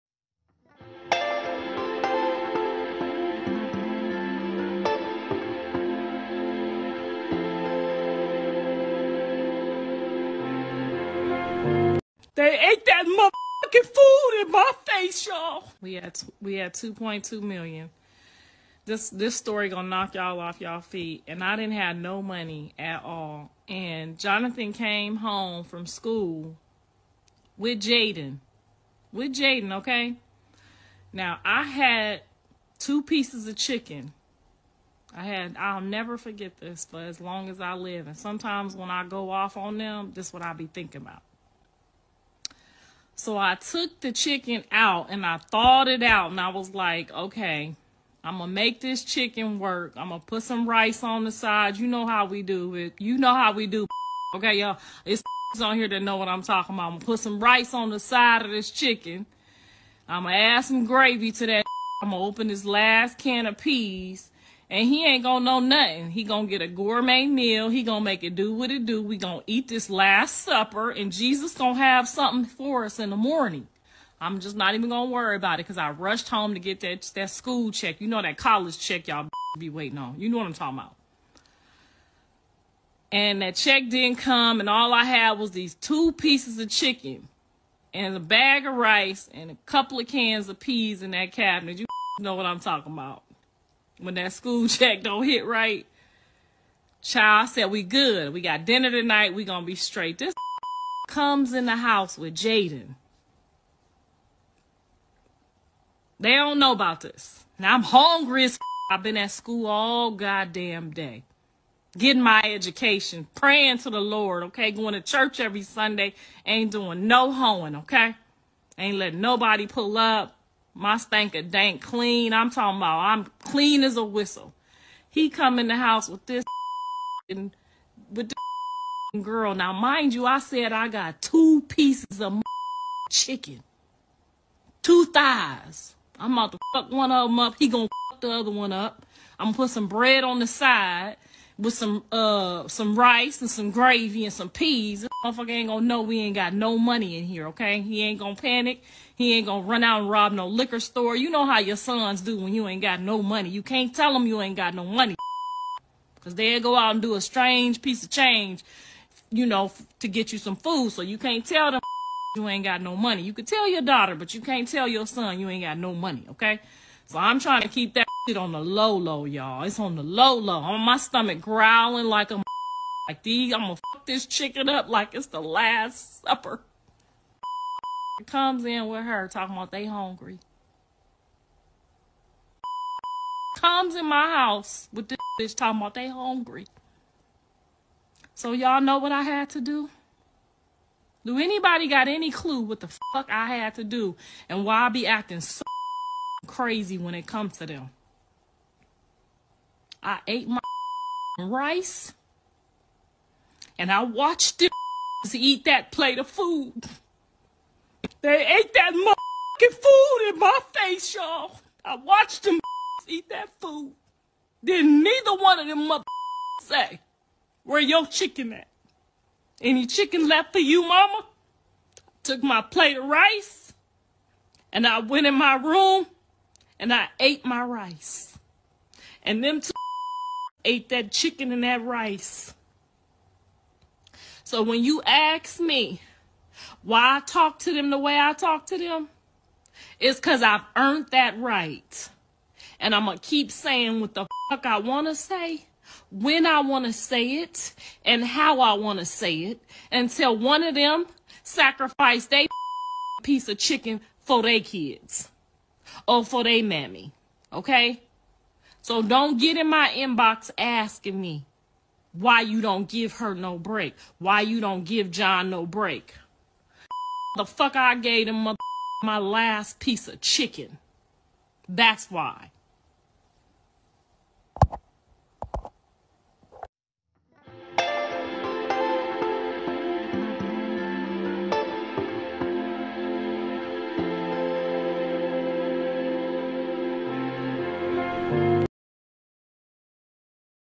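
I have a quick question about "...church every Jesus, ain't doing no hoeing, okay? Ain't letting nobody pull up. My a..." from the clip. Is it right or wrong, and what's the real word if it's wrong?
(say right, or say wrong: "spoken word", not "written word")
wrong: "Sunday", not "Jesus".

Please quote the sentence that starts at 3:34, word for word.
Then neither one of them motherfuckers say, where your chicken at?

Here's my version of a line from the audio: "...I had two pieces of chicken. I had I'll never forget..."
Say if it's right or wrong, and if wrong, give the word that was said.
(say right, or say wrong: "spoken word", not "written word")
right.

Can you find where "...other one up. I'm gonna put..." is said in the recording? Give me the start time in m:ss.
2:18.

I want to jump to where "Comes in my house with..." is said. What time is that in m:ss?
3:03.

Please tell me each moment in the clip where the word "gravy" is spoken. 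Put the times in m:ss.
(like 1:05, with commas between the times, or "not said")
1:00, 2:23.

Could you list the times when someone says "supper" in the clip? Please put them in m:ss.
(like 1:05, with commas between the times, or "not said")
1:10, 2:56.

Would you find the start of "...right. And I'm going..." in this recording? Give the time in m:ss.
4:01.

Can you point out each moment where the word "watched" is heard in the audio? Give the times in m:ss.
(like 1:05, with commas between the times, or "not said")
3:24, 3:31.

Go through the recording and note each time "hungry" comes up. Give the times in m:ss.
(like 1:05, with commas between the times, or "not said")
1:47, 2:59, 3:06.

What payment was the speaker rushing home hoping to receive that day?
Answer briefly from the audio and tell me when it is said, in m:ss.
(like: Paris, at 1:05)
school check, at 1:17.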